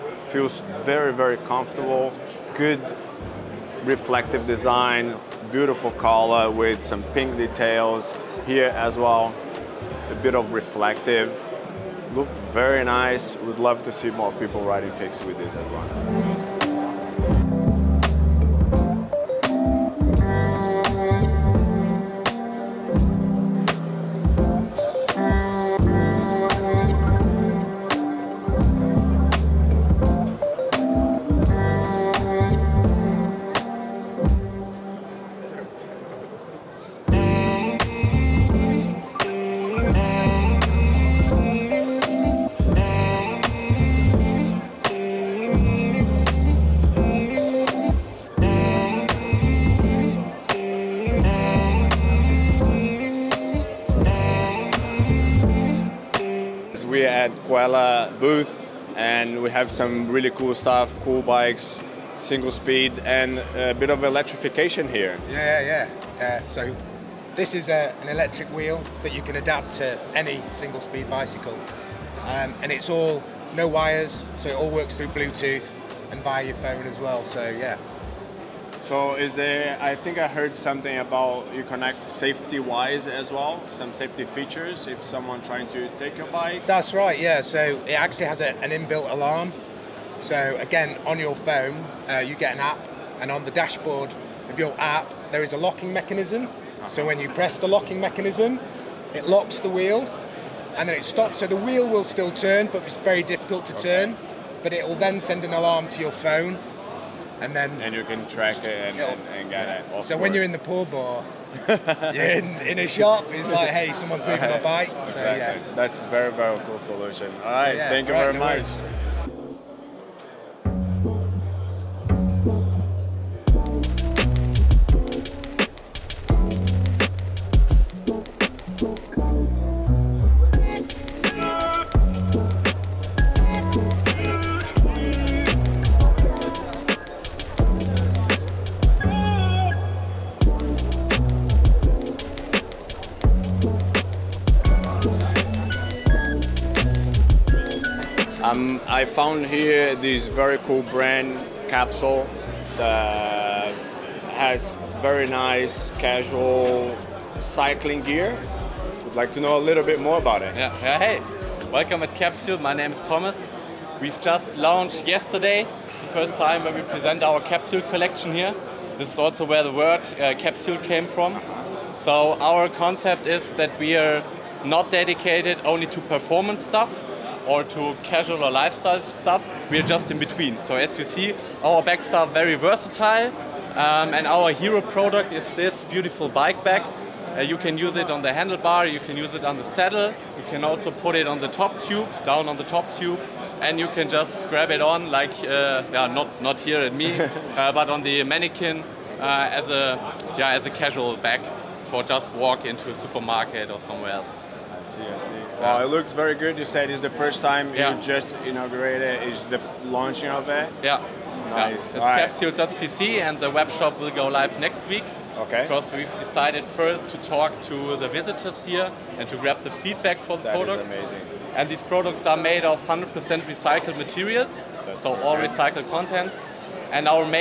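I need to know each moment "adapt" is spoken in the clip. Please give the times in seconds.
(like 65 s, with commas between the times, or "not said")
69 s.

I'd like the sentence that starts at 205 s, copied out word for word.
Wow, uh, it looks very good.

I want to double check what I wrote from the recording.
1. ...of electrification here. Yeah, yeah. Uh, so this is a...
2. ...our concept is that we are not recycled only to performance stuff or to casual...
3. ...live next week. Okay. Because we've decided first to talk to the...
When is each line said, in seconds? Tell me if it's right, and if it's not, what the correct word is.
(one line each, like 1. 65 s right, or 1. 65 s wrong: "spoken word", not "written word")
1. 63 s right
2. 172 s wrong: "dedicated", not "recycled"
3. 214 s right.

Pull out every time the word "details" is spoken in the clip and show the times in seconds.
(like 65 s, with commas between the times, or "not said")
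7 s.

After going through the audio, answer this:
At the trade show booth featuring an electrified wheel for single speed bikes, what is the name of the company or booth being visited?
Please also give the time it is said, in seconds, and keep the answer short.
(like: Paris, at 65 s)
Quella, at 57 s.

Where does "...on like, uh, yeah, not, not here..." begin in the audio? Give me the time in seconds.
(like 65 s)
194 s.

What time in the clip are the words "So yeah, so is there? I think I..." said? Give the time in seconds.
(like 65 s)
77 s.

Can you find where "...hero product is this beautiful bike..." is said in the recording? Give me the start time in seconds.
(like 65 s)
184 s.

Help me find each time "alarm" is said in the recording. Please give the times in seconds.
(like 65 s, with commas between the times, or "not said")
89 s, 105 s.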